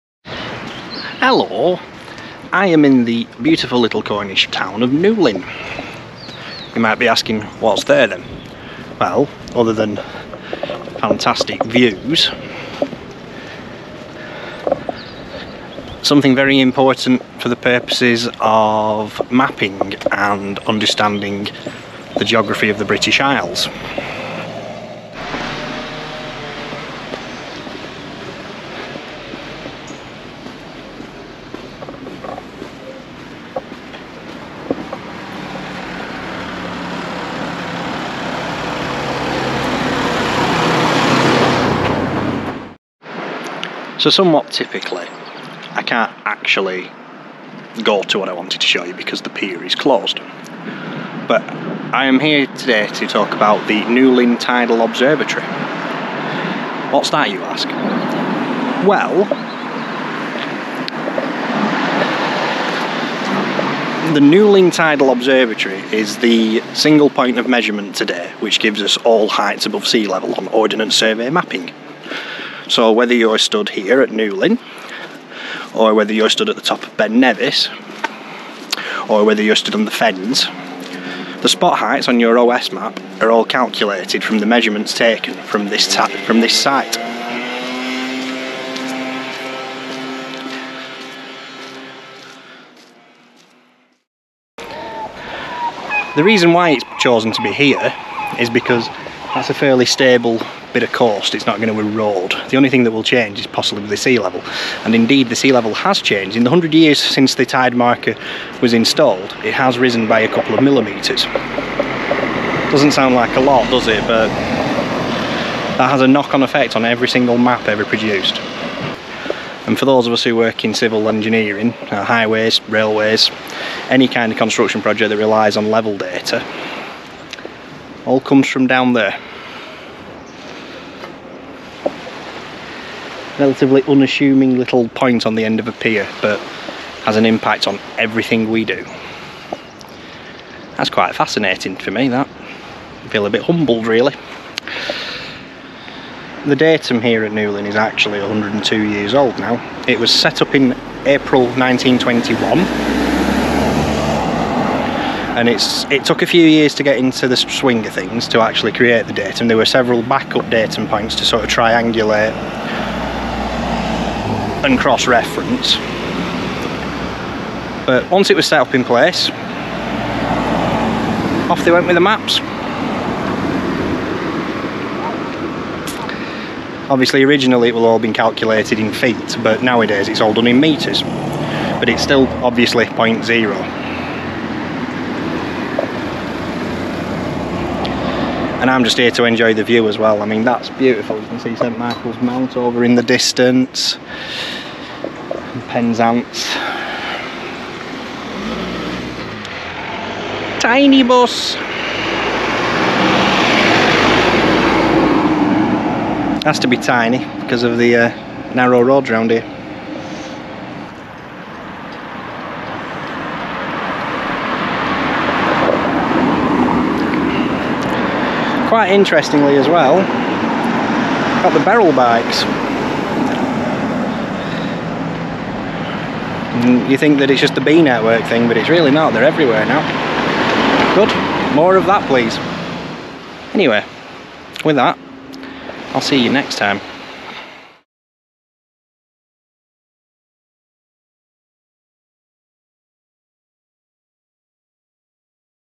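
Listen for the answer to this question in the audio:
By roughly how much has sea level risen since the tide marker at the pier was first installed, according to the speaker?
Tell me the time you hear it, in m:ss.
1:50.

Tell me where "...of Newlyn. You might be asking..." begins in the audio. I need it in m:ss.
0:04.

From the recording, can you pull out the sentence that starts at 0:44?
So somewhat typically, I can't actually go to what I wanted to show you because the pier is closed.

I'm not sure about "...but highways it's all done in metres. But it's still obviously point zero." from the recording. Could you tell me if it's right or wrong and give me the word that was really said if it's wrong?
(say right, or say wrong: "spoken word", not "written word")
wrong: "nowadays", not "highways".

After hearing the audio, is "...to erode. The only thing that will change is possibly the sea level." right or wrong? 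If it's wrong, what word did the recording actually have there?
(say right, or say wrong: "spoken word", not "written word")
right.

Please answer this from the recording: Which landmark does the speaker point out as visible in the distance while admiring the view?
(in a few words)
St Michael's Mount.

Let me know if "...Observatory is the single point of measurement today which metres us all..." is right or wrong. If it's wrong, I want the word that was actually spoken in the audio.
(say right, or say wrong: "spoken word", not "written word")
wrong: "gives", not "metres".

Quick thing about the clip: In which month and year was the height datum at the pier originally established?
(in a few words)
April 1921.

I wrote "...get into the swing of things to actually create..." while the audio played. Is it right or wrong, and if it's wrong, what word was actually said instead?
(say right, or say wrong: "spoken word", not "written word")
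right.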